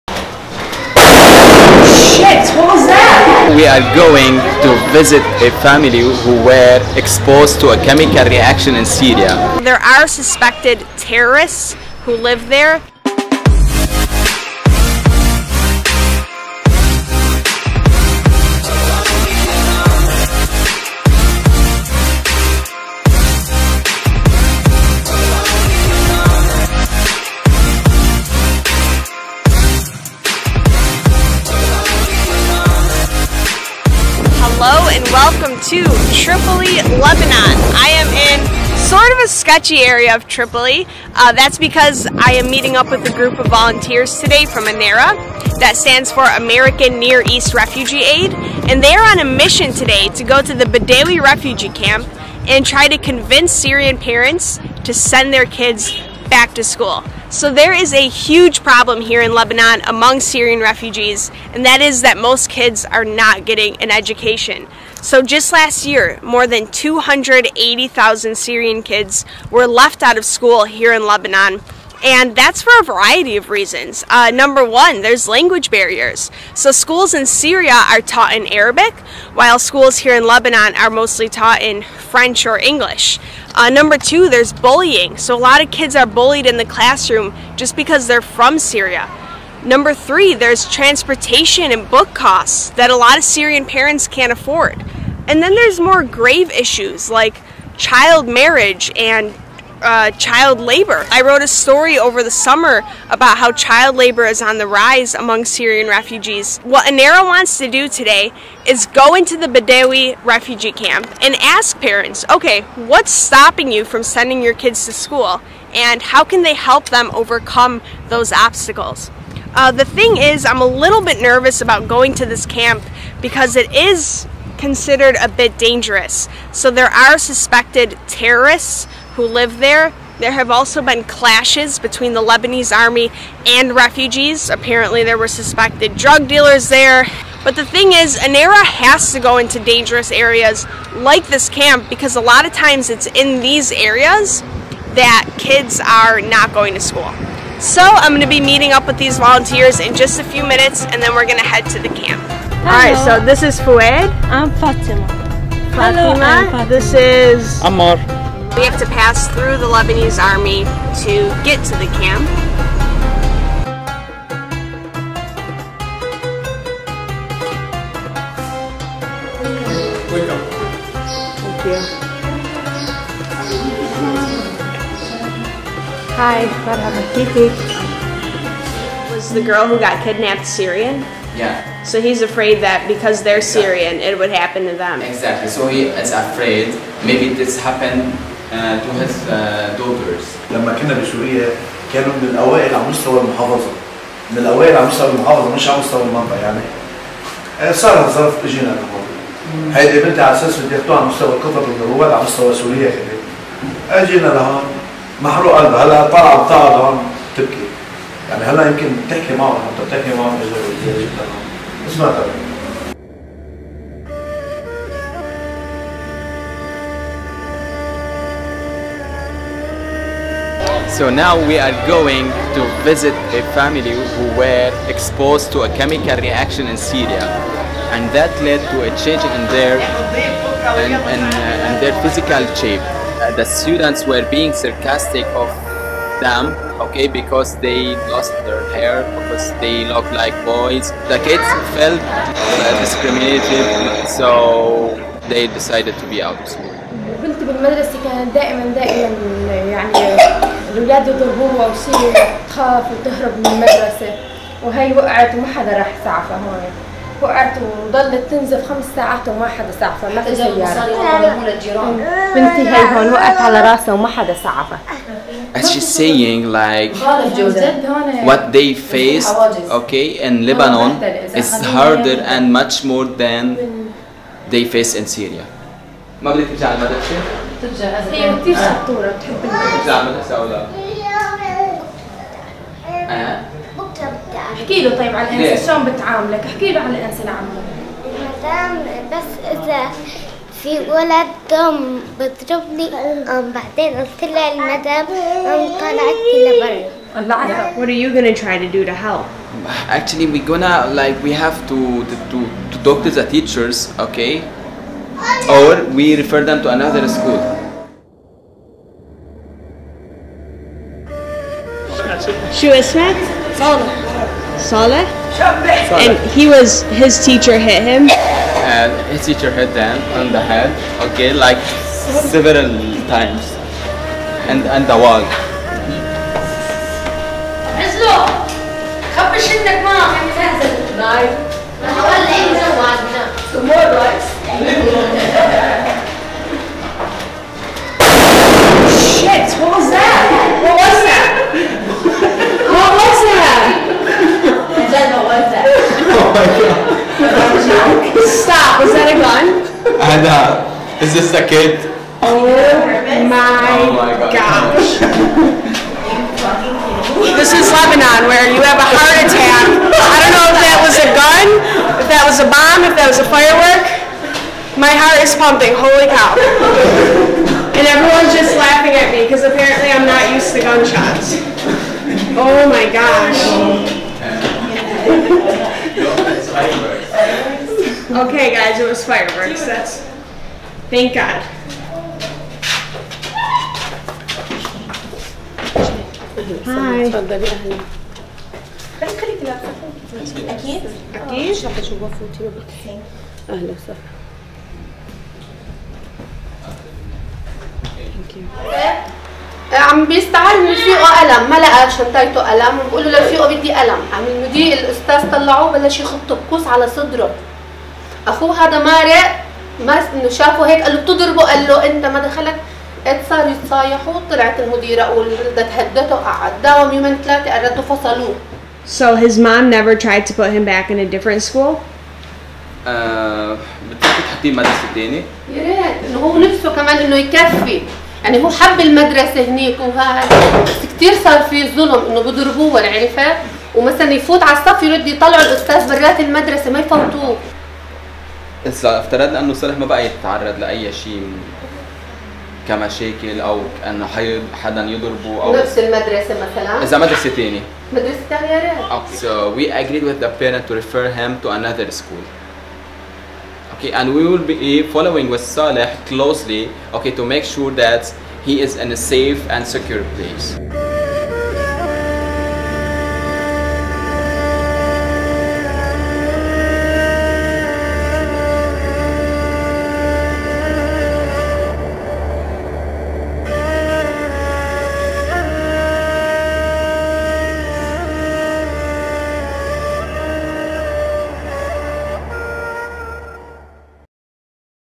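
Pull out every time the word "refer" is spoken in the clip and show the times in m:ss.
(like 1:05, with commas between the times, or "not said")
5:06.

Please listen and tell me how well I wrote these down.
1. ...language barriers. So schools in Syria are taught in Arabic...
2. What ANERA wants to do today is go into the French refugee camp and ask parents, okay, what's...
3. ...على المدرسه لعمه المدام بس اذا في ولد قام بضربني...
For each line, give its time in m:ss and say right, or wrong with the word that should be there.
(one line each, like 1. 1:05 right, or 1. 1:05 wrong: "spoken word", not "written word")
1. 1:15 right
2. 1:46 wrong: "Badawi", not "French"
3. 4:46 wrong: "الانسه", not "المدرسه".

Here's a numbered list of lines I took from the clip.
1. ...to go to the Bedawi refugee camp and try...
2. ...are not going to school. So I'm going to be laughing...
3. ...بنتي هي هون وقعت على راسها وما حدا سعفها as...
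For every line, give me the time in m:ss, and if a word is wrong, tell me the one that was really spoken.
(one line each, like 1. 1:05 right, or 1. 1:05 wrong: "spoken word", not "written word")
1. 0:50 right
2. 2:25 wrong: "meeting", not "laughing"
3. 4:22 right.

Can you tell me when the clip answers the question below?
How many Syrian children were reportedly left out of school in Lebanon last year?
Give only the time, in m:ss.
1:06.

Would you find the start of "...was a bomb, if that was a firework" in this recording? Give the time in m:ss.
6:02.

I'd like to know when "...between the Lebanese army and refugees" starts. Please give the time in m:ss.
2:11.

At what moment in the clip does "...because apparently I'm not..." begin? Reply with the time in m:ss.
6:09.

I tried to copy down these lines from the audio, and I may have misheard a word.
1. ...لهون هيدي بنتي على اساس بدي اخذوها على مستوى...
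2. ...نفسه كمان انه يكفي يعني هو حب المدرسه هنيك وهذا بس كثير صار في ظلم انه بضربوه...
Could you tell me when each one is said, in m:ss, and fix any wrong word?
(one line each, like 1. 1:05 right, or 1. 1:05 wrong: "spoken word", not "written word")
1. 3:18 right
2. 7:06 right.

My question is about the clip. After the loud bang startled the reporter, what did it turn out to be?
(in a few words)
fireworks.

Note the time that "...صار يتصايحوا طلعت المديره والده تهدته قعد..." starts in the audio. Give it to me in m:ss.
6:53.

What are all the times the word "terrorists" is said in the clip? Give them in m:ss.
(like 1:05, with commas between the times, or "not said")
0:10, 2:08.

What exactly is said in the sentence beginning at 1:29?
Number three, there's transportation and book costs that a lot of Syrian parents can't afford.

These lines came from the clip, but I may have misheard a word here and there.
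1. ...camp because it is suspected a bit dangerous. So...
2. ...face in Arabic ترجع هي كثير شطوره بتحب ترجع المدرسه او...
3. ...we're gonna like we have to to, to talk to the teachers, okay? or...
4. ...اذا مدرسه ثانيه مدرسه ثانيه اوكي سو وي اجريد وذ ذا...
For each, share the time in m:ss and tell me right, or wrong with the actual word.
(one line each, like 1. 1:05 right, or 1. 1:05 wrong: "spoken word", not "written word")
1. 2:02 wrong: "considered", not "suspected"
2. 4:34 wrong: "Syria", not "Arabic"
3. 5:00 right
4. 7:26 right.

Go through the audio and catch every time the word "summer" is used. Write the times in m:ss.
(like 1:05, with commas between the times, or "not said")
1:42.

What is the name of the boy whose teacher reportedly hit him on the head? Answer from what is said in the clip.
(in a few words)
Saleh.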